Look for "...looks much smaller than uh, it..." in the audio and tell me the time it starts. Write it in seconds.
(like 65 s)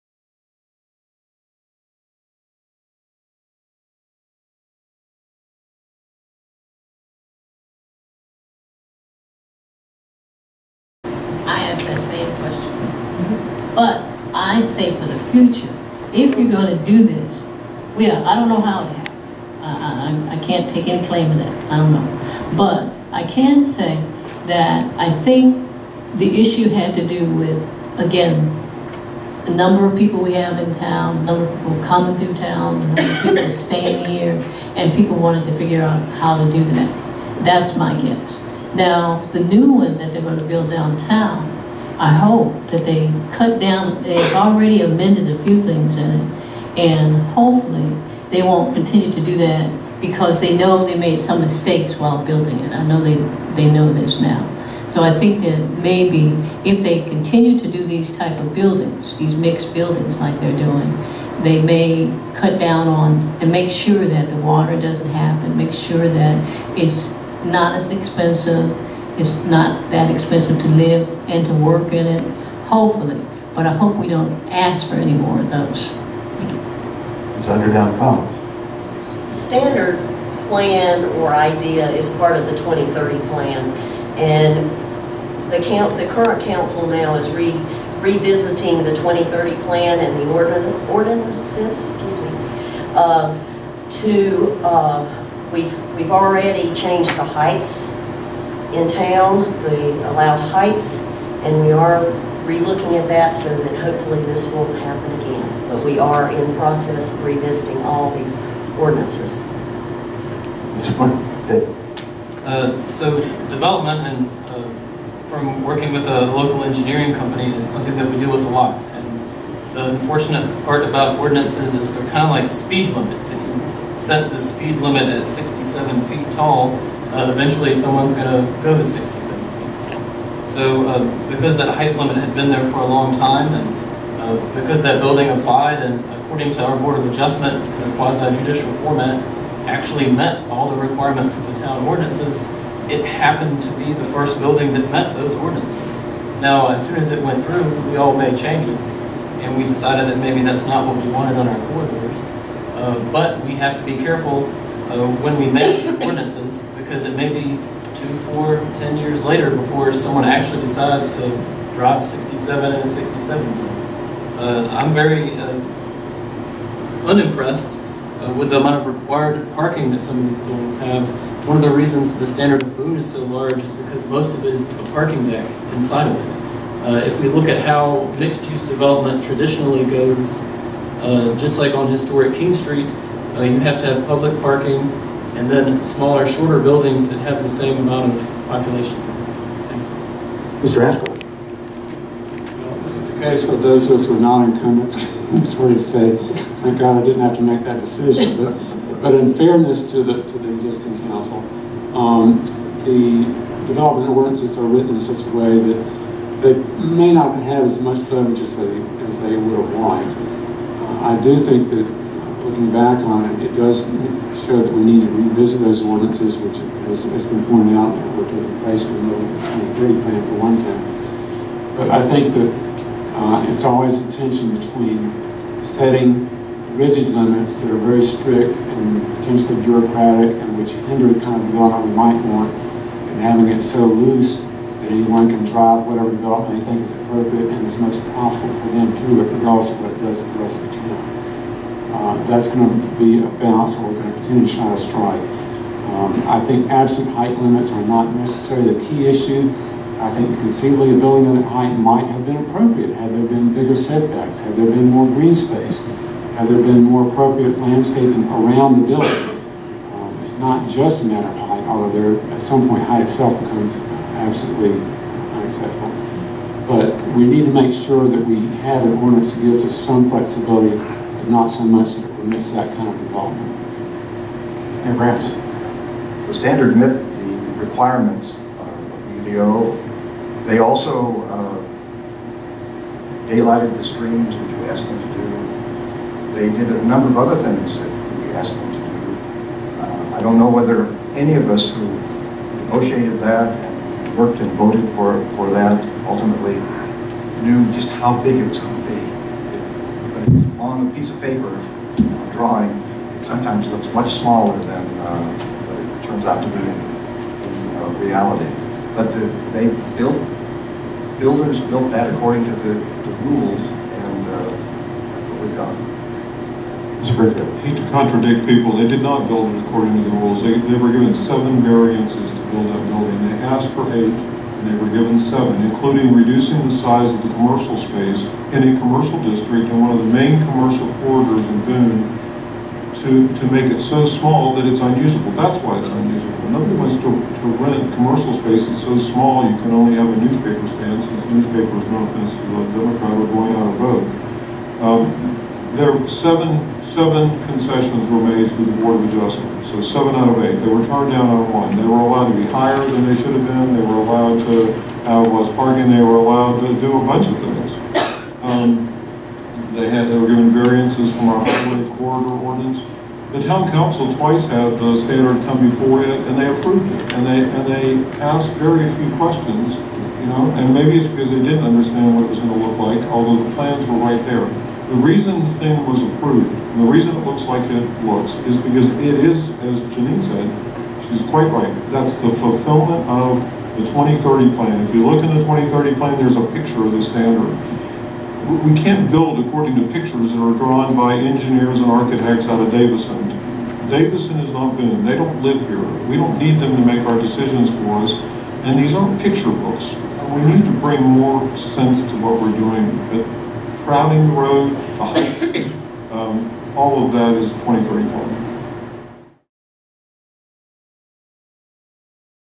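303 s.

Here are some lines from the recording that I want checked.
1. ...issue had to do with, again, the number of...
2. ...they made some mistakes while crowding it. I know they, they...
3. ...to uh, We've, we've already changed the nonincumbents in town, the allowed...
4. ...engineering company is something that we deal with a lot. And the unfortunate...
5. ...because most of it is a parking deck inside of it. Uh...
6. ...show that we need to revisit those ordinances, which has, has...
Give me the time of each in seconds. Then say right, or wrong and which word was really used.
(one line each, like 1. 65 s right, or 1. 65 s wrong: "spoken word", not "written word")
1. 26 s right
2. 50 s wrong: "building", not "crowding"
3. 93 s wrong: "heights", not "nonincumbents"
4. 116 s right
5. 173 s right
6. 214 s right.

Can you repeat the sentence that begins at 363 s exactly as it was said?
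The town council twice had the standard come before it, and they approved it.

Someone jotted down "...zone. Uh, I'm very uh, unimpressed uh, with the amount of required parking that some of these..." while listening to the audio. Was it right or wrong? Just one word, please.
right.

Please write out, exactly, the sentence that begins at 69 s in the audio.
It's not that expensive to live and to work in it, hopefully.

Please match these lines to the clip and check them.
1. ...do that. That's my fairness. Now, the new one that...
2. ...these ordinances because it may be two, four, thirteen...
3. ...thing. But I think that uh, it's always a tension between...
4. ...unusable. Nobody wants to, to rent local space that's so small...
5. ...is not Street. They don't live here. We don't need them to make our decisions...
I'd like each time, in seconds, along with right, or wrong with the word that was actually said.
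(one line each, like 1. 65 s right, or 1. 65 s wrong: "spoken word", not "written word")
1. 36 s wrong: "guess", not "fairness"
2. 155 s wrong: "ten", not "thirteen"
3. 220 s right
4. 335 s wrong: "commercial", not "local"
5. 394 s wrong: "Boone", not "Street".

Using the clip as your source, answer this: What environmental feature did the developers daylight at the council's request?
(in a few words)
the streams.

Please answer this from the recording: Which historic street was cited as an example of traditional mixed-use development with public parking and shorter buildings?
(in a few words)
King Street.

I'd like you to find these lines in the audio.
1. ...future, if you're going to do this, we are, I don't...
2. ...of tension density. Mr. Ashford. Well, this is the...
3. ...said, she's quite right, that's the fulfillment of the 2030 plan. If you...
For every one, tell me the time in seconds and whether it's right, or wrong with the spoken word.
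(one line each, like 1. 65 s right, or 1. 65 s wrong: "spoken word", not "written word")
1. 15 s right
2. 188 s wrong: "population", not "tension"
3. 380 s right.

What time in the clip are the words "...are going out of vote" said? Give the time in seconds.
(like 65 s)
343 s.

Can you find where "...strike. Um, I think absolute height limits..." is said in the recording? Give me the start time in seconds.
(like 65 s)
244 s.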